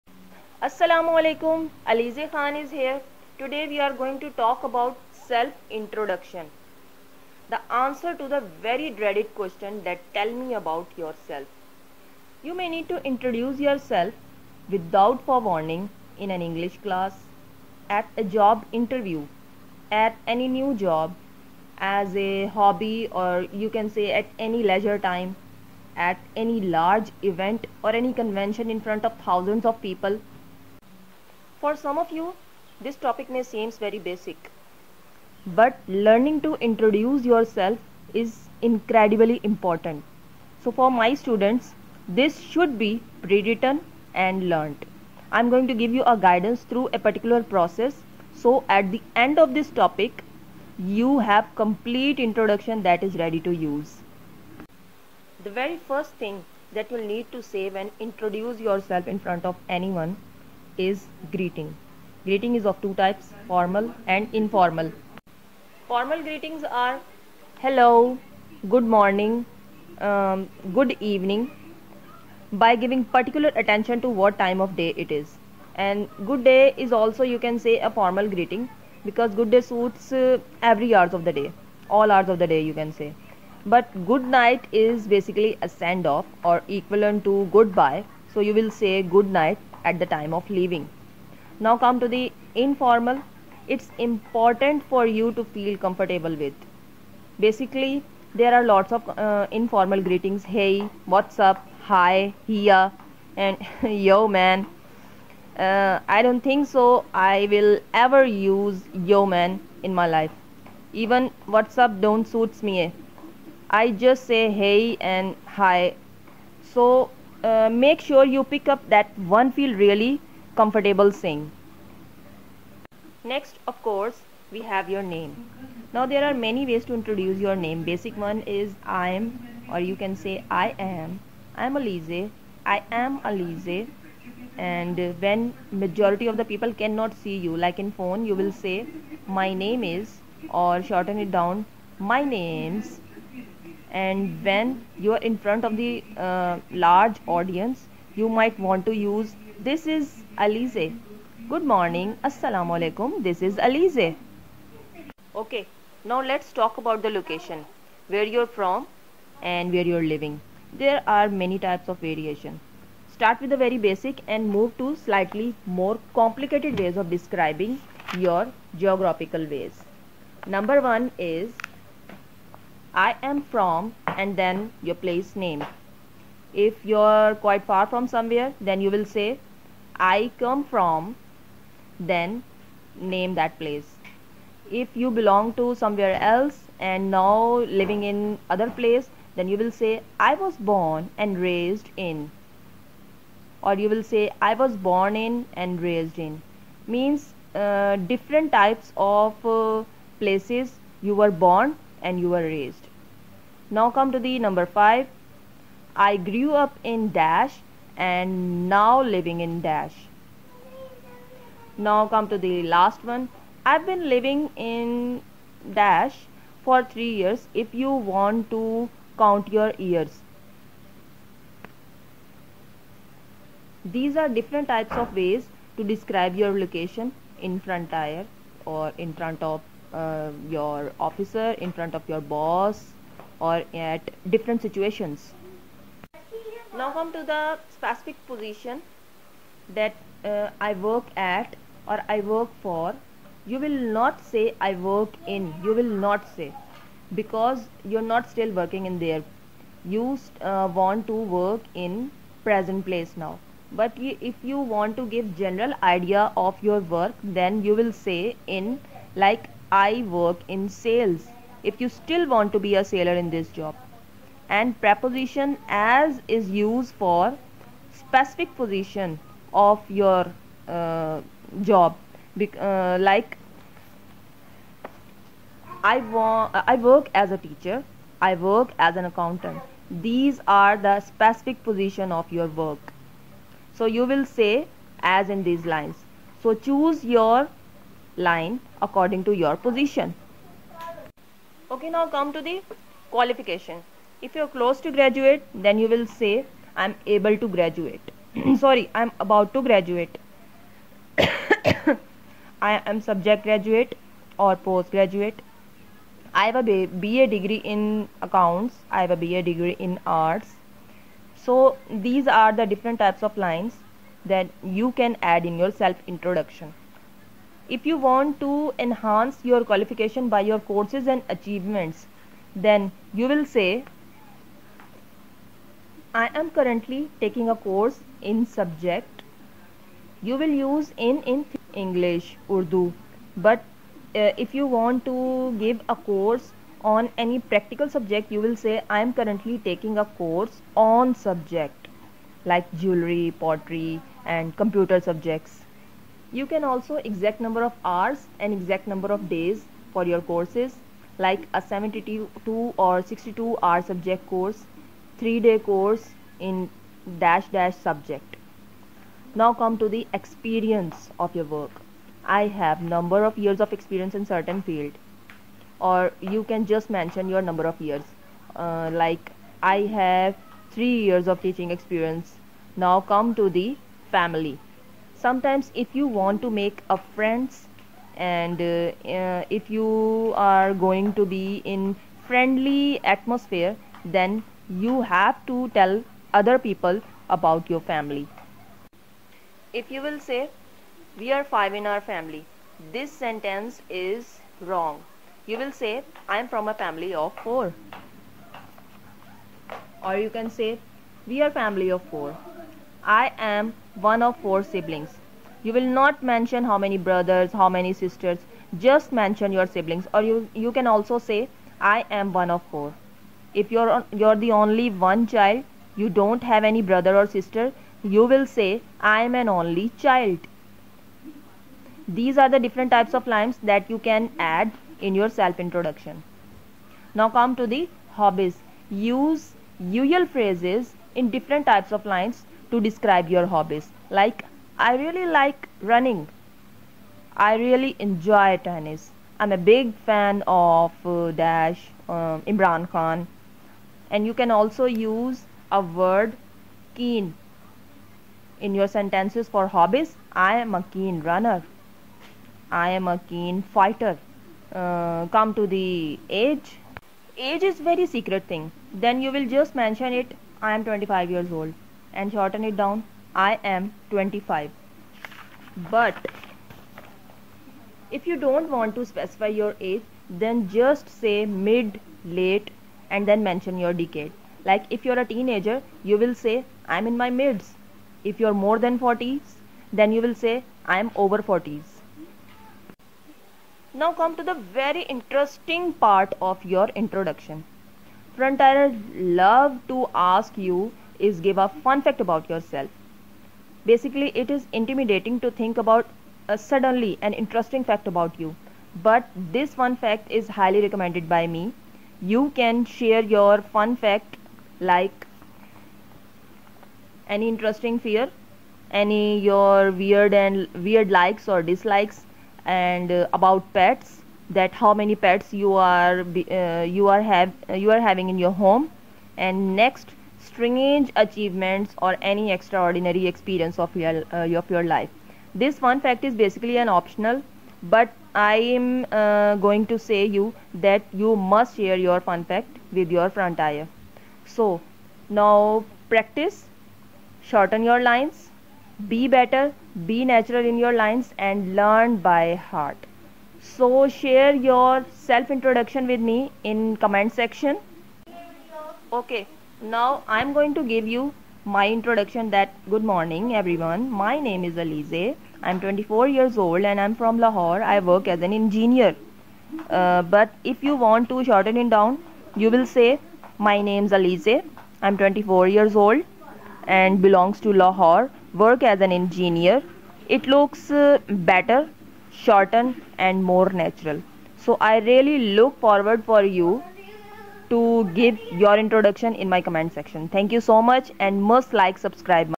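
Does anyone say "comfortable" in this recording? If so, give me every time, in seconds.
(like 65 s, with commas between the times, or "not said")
95 s, 120 s.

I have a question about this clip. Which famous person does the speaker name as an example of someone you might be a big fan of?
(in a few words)
Imran Khan.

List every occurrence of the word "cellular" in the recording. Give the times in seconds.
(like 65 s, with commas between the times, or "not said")
not said.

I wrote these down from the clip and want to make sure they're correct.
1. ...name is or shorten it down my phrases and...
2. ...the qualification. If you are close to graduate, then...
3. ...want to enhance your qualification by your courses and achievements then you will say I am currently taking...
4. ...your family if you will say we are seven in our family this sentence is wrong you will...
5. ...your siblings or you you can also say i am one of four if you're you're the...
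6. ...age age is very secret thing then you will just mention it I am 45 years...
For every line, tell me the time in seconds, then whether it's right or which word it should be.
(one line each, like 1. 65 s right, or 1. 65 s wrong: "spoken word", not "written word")
1. 139 s wrong: "names", not "phrases"
2. 292 s right
3. 318 s right
4. 387 s wrong: "five", not "seven"
5. 409 s right
6. 456 s wrong: "25", not "45".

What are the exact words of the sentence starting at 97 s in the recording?
Basically, there are lots of uh, informal greetings.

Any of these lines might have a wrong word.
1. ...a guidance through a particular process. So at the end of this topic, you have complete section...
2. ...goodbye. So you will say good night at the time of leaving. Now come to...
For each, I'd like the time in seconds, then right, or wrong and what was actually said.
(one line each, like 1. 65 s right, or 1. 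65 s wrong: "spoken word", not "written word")
1. 46 s wrong: "introduction", not "section"
2. 87 s right.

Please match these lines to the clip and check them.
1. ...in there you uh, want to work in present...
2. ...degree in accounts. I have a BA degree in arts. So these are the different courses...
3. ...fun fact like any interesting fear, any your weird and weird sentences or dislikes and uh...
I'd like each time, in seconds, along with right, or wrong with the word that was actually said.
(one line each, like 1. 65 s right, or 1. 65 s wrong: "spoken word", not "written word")
1. 248 s right
2. 307 s wrong: "types", not "courses"
3. 503 s wrong: "likes", not "sentences".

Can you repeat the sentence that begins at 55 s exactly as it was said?
The very first thing that you'll need to say when introduce yourself in front of anyone is greeting.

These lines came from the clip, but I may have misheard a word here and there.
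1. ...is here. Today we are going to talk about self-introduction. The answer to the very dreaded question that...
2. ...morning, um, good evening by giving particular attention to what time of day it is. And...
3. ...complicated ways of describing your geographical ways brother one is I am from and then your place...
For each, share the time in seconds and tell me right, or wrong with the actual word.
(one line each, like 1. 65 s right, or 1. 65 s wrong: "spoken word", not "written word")
1. 2 s right
2. 68 s right
3. 166 s wrong: "number", not "brother".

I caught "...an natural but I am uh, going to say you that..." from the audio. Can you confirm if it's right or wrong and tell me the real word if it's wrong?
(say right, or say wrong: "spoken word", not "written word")
wrong: "optional", not "natural".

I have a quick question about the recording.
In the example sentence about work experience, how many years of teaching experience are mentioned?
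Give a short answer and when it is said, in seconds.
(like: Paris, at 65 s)
3, at 370 s.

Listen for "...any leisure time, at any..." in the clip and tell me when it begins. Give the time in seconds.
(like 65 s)
24 s.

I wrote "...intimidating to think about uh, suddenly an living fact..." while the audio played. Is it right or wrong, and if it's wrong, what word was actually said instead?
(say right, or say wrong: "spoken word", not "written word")
wrong: "interesting", not "living".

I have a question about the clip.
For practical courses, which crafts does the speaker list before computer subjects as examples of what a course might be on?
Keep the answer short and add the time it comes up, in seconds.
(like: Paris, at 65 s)
Jewelry, pottery, at 342 s.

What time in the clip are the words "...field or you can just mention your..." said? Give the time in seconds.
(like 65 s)
364 s.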